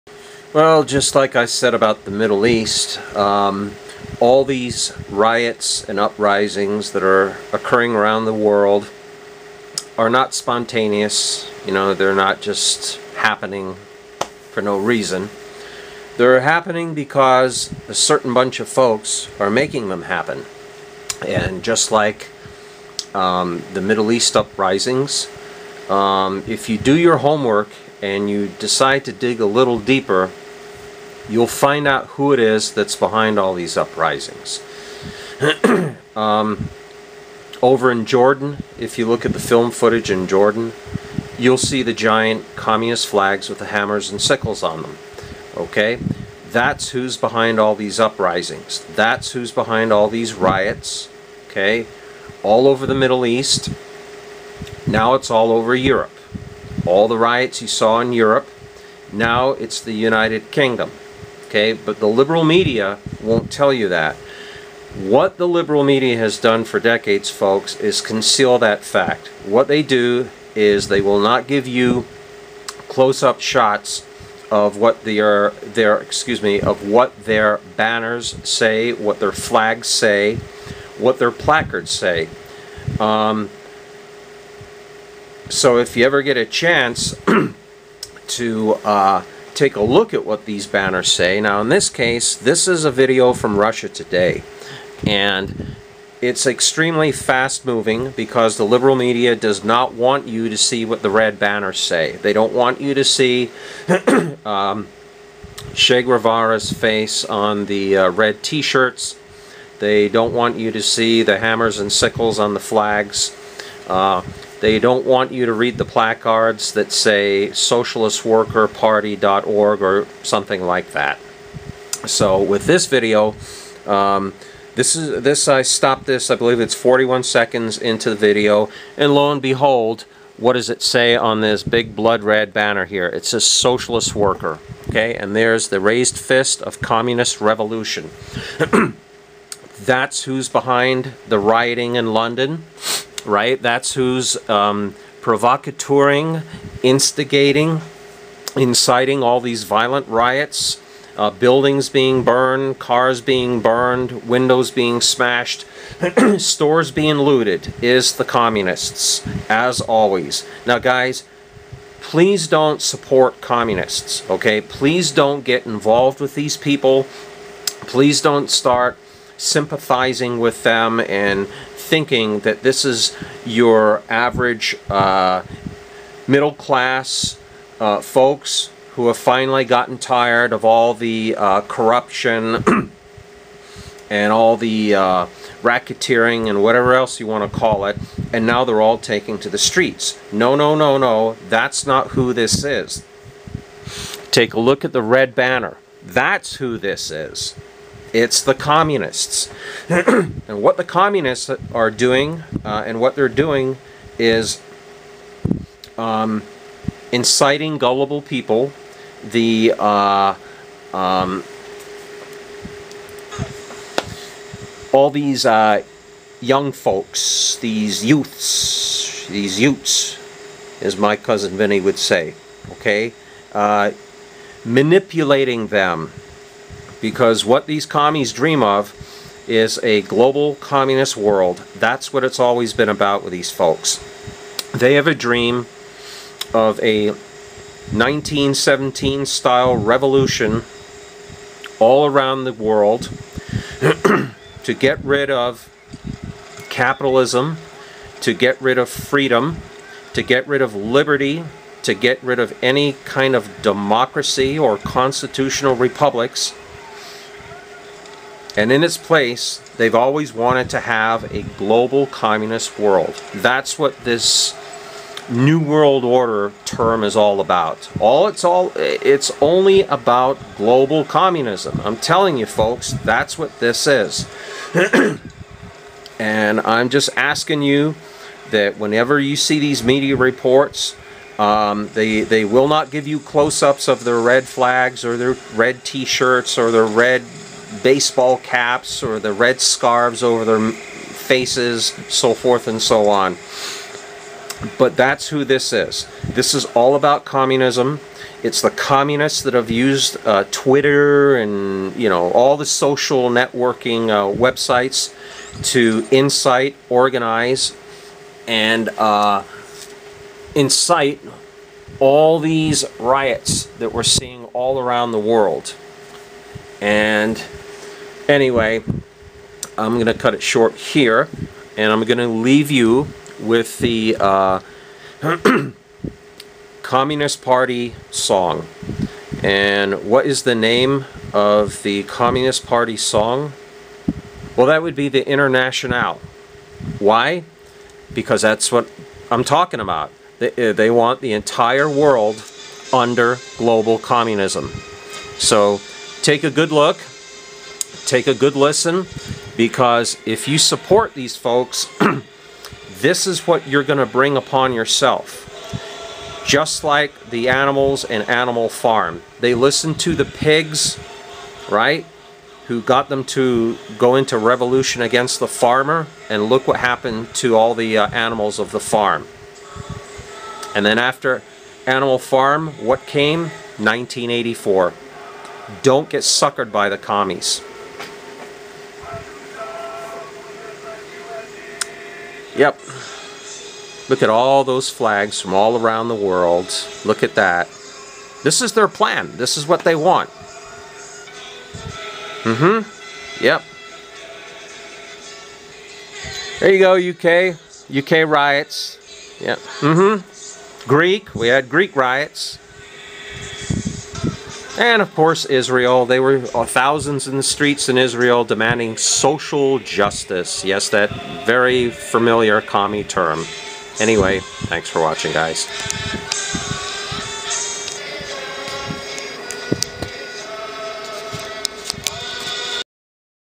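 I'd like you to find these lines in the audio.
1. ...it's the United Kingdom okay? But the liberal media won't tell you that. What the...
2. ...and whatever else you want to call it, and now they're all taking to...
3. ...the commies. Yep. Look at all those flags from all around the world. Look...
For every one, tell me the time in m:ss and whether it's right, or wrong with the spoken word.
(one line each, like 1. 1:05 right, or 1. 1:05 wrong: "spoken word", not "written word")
1. 0:59 right
2. 3:06 right
3. 6:16 right.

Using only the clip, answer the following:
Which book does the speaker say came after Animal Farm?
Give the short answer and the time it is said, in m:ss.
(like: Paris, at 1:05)
1984, at 6:13.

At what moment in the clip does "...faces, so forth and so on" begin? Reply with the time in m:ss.
4:50.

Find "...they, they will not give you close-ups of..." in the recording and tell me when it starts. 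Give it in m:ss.
4:41.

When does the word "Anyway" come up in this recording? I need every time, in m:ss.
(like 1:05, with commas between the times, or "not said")
5:18, 6:53.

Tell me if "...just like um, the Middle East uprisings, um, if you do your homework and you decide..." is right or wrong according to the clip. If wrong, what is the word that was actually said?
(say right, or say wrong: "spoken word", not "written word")
right.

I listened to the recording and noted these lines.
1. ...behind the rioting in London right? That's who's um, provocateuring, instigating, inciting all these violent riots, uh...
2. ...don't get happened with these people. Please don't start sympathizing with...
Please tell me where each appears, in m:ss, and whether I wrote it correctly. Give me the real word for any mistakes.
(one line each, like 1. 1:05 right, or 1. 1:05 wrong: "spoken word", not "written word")
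1. 2:20 right
2. 2:45 wrong: "involved", not "happened".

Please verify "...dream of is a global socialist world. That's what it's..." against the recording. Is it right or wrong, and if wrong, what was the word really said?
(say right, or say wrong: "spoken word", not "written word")
wrong: "communist", not "socialist".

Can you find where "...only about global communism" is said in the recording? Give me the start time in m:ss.
4:29.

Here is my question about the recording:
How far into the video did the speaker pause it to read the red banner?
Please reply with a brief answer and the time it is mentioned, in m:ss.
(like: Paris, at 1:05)
41 seconds, at 2:06.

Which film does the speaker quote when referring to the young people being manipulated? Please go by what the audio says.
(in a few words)
My Cousin Vinny.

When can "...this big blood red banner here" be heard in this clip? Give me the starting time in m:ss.
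2:11.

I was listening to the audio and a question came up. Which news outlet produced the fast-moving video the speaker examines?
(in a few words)
Russia Today.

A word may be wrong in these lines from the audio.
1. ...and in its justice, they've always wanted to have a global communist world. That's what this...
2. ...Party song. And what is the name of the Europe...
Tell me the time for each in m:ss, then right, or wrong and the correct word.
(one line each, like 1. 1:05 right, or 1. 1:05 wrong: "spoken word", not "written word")
1. 4:18 wrong: "place", not "justice"
2. 5:27 wrong: "Communist", not "Europe".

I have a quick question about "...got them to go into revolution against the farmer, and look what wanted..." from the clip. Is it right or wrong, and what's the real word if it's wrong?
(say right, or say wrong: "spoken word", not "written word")
wrong: "happened", not "wanted".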